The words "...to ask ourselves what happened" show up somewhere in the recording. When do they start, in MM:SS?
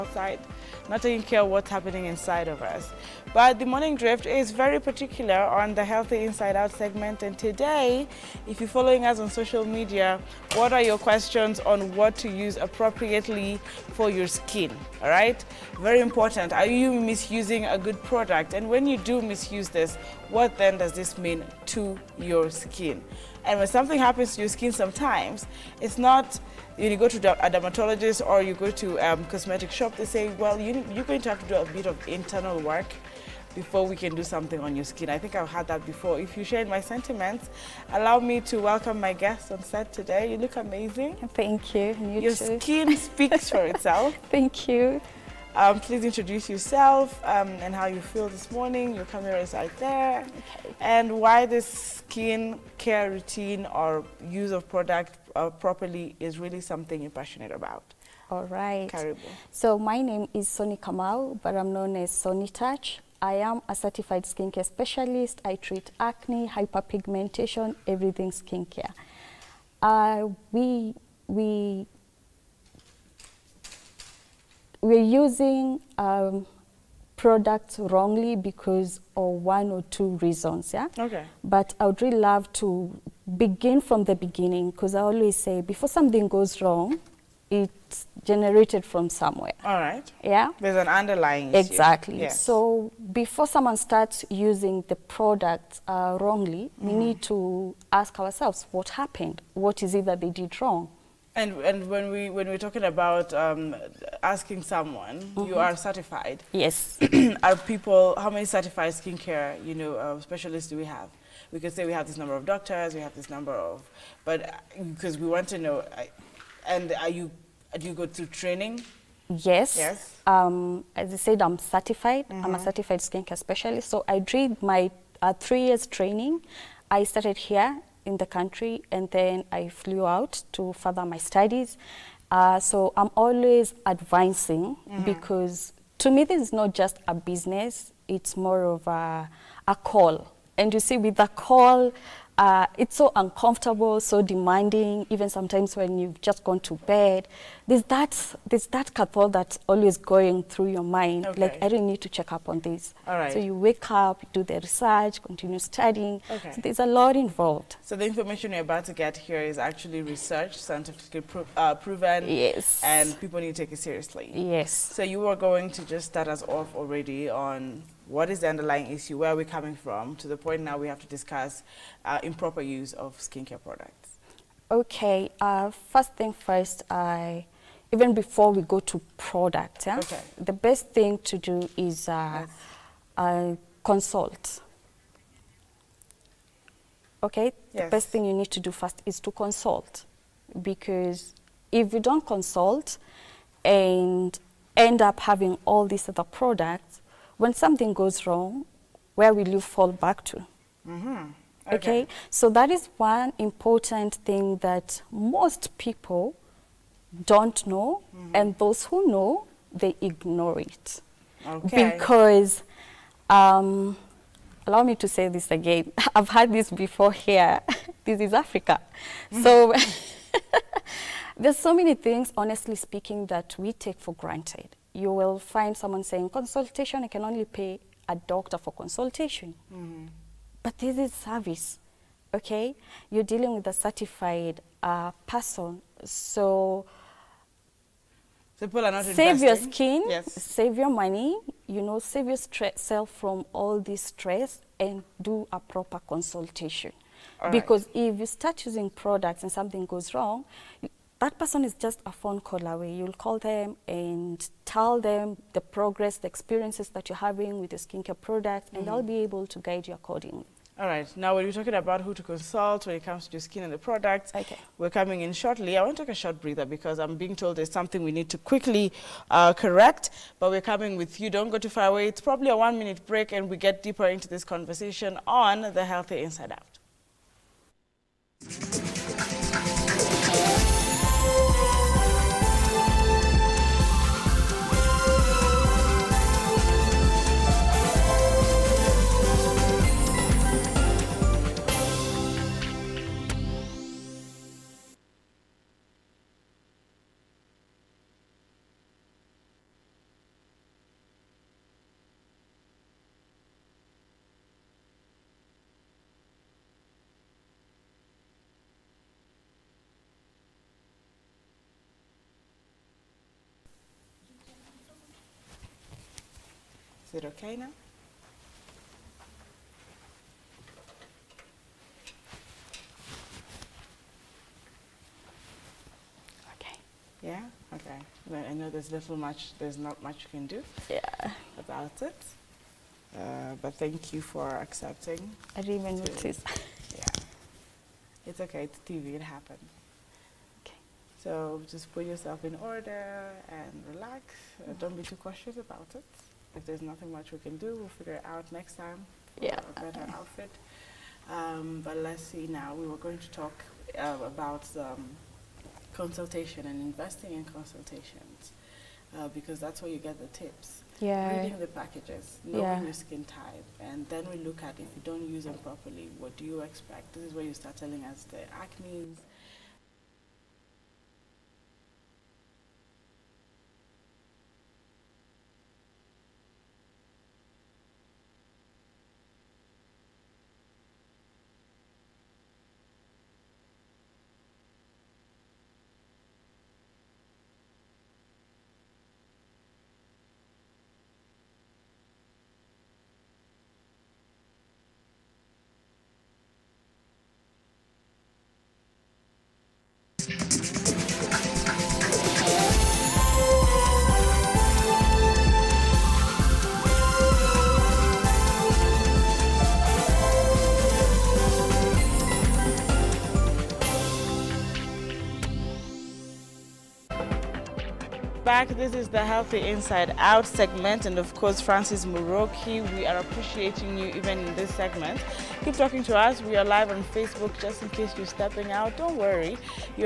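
01:37.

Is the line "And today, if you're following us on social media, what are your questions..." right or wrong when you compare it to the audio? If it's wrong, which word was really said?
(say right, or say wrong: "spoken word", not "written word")
right.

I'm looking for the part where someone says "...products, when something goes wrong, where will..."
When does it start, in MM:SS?
03:16.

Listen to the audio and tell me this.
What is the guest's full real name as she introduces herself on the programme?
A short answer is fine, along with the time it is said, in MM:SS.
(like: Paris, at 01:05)
Soni Kamau, at 01:00.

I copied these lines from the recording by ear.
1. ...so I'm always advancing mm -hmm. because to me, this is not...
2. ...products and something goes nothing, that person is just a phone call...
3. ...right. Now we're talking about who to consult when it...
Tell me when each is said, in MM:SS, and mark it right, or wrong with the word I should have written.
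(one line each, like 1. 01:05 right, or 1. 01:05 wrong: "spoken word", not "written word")
1. 02:12 right
2. 04:08 wrong: "wrong", not "nothing"
3. 04:20 right.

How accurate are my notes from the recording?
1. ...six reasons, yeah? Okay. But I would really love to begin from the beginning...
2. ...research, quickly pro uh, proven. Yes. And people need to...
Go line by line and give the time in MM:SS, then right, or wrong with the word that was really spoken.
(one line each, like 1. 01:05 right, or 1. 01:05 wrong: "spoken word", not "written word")
1. 01:19 wrong: "two", not "six"
2. 02:40 wrong: "scientifically", not "quickly".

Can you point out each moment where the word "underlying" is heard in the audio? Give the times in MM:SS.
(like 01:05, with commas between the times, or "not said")
01:30, 02:48.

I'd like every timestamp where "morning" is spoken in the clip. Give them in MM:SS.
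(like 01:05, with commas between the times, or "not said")
00:03, 00:48.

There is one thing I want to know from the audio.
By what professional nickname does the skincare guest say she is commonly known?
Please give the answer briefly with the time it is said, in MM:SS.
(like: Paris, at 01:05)
Soni Touch, at 01:02.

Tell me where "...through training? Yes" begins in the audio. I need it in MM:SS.
01:58.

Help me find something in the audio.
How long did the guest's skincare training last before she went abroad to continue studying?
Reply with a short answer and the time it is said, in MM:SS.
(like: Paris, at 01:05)
3 years, at 02:05.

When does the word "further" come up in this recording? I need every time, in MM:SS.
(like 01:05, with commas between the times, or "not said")
02:10.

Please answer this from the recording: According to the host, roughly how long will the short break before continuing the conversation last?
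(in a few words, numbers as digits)
1 minute.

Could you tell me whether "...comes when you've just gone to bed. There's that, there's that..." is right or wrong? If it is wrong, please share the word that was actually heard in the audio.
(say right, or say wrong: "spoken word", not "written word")
wrong: "sometimes", not "comes".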